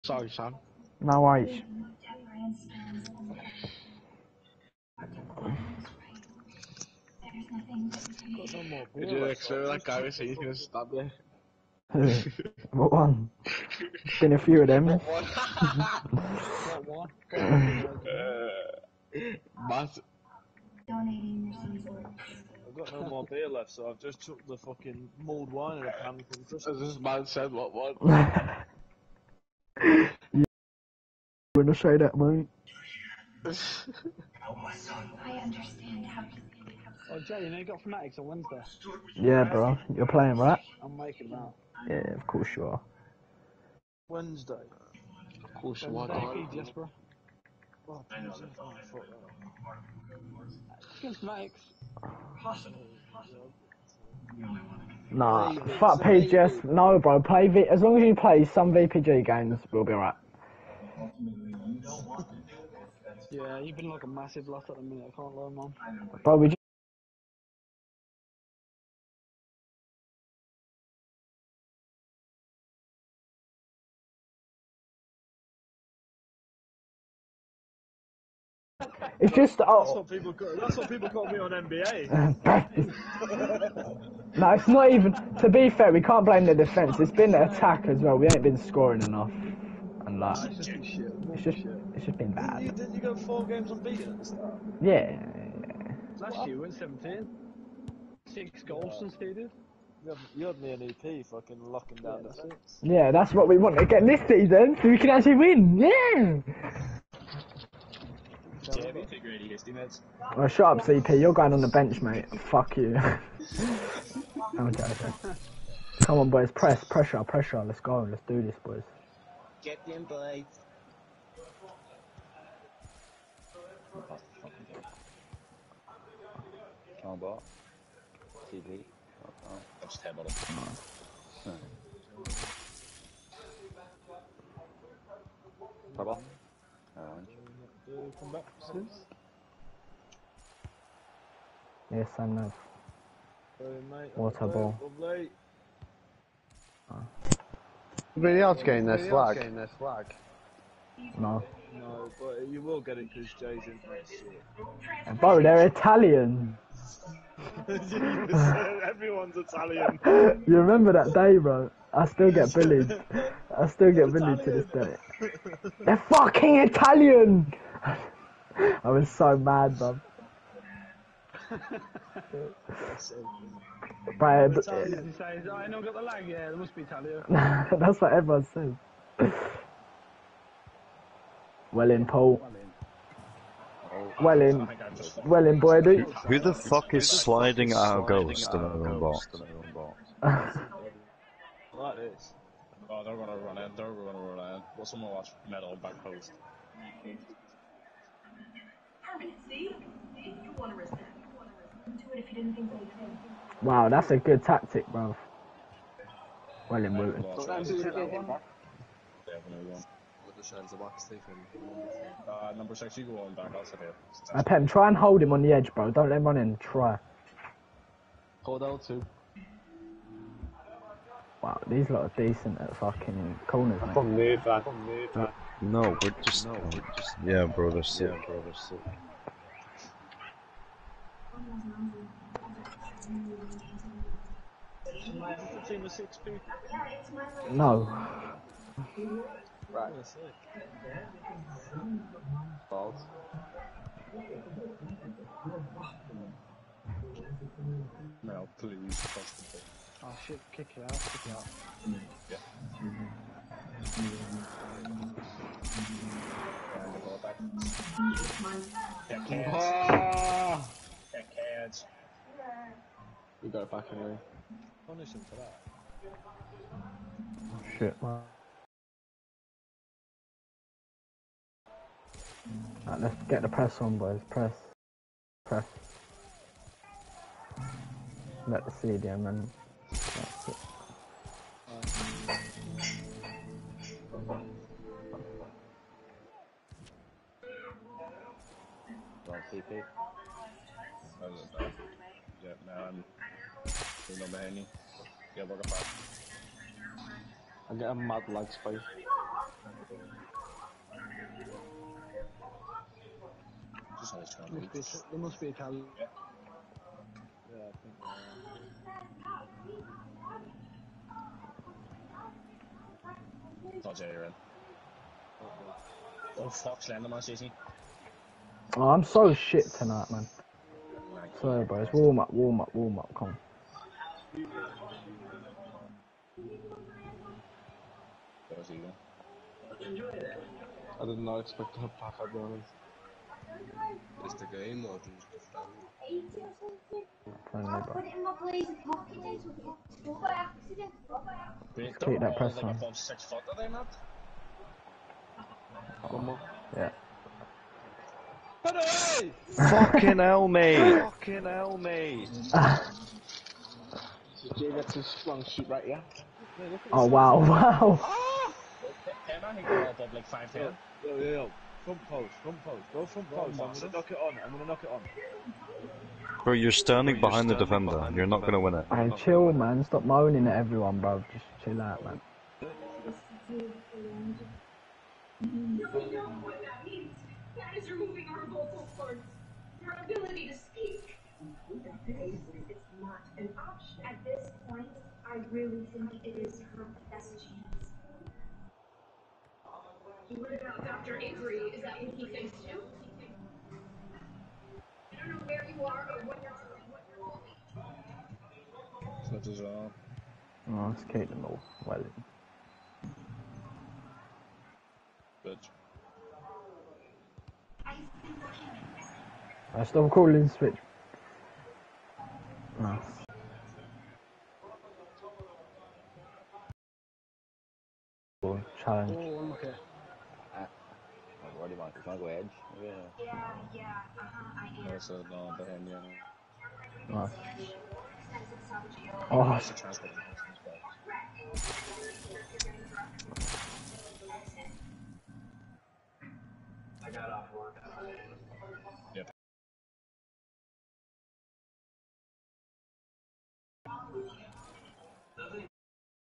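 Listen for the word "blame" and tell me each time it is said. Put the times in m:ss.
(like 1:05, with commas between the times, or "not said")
1:26.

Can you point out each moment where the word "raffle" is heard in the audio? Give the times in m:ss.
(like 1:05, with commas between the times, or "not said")
not said.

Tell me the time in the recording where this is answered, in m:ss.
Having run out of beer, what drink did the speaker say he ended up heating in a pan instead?
0:25.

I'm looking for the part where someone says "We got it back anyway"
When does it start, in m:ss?
4:23.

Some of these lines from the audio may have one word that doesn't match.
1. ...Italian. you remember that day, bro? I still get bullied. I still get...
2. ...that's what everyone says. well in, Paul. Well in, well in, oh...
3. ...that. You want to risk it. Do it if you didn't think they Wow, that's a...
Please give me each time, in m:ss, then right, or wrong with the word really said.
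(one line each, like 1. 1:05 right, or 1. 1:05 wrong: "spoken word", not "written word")
1. 2:39 right
2. 2:57 right
3. 3:20 right.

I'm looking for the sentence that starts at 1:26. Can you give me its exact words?
It's been the attack as well.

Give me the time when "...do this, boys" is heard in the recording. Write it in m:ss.
1:58.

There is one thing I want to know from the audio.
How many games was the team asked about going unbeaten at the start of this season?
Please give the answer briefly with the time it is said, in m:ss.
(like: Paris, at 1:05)
4, at 1:33.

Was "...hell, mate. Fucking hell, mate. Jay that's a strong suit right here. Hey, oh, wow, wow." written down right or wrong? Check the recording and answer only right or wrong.
right.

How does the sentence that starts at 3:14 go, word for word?
What's someone watch metal back post?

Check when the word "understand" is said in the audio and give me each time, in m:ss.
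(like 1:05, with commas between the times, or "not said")
0:35.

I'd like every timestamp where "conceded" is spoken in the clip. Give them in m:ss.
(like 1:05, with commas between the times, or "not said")
1:39.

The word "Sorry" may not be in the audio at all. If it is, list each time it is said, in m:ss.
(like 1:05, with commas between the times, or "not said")
0:00, 2:23.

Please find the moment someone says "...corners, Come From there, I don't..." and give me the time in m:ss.
3:43.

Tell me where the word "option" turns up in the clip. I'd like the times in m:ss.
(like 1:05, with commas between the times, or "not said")
6:23.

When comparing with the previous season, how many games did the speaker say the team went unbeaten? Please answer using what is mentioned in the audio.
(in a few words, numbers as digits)
17.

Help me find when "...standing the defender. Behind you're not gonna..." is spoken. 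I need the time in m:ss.
6:07.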